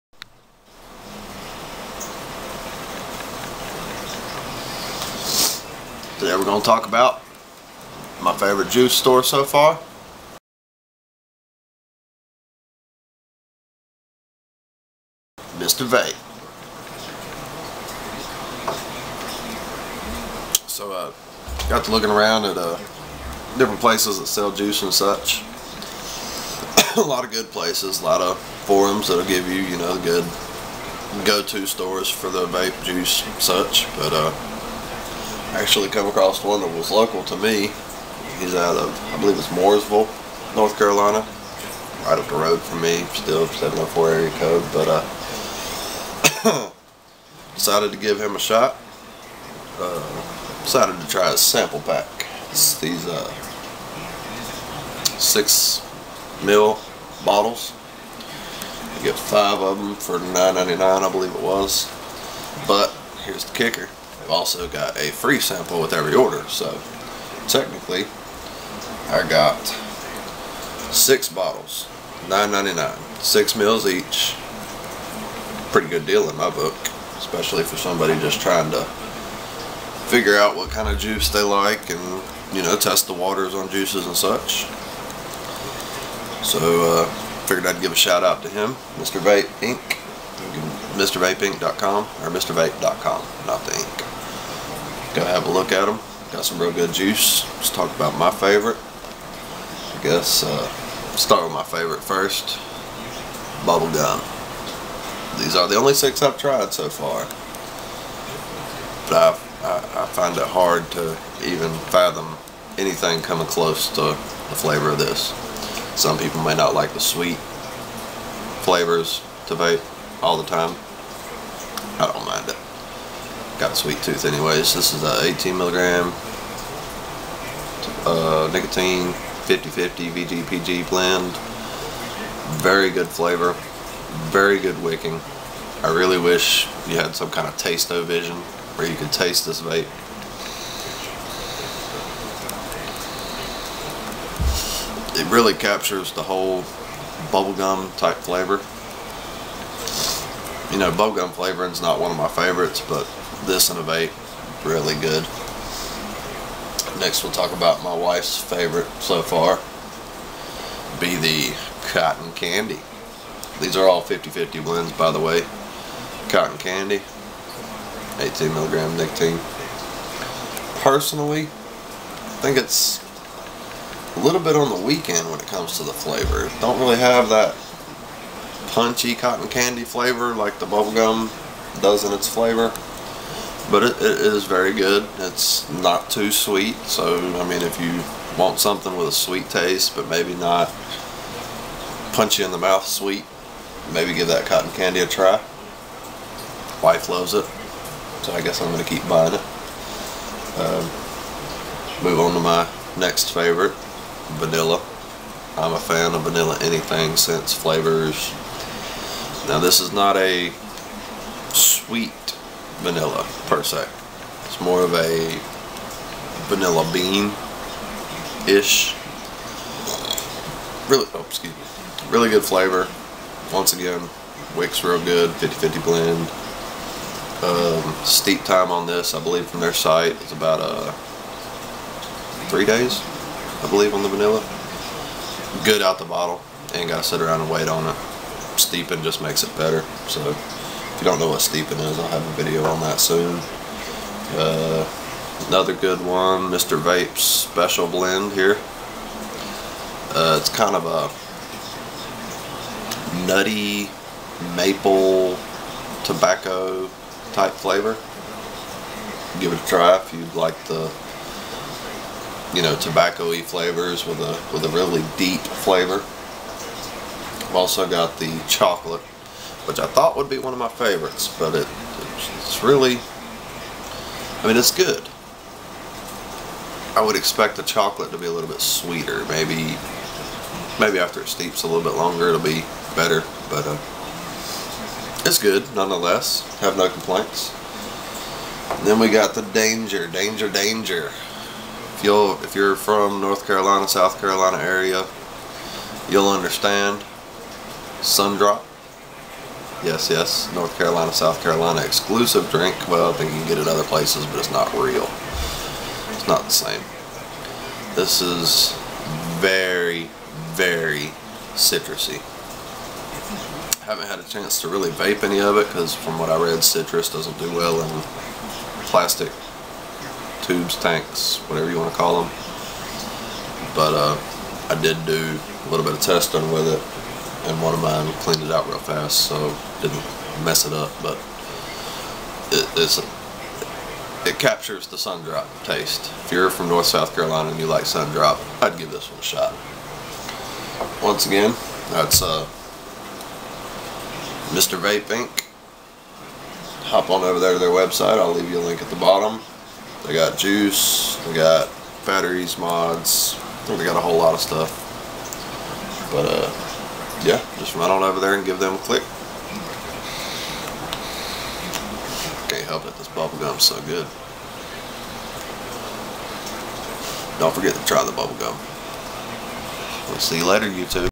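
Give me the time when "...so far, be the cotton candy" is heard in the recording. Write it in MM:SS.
02:39.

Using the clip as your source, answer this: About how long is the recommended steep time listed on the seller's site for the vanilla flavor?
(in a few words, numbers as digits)
3 days.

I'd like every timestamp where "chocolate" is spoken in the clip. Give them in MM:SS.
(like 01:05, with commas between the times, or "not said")
04:28, 04:37.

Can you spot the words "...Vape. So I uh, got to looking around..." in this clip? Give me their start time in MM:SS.
00:15.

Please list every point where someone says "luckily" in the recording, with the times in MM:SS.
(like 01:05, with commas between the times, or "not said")
not said.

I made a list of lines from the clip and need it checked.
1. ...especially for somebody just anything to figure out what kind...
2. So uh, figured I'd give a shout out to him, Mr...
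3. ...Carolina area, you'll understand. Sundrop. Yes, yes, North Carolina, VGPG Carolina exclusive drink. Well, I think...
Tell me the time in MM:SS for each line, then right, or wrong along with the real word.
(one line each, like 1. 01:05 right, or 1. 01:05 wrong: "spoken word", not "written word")
1. 01:17 wrong: "trying", not "anything"
2. 01:26 right
3. 04:54 wrong: "South", not "VGPG".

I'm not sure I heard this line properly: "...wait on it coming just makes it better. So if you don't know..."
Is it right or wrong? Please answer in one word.
wrong.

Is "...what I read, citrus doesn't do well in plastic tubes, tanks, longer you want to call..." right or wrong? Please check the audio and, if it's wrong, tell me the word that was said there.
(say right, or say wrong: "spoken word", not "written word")
wrong: "whatever", not "longer".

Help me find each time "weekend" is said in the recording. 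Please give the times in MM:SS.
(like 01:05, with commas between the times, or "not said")
02:54.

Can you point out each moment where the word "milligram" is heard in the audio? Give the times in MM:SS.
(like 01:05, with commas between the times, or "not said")
02:05, 02:48.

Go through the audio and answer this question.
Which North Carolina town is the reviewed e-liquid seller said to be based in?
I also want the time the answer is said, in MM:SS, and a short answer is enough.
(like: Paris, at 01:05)
Mooresville, at 00:39.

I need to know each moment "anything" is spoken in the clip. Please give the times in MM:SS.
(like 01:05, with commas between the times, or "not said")
01:52, 03:26.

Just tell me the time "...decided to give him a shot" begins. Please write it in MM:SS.
00:47.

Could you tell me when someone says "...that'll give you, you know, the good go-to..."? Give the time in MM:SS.
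00:29.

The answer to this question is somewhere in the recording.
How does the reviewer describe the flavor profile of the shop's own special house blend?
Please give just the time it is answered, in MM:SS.
04:13.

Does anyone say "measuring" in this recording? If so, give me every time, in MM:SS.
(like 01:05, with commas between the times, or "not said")
not said.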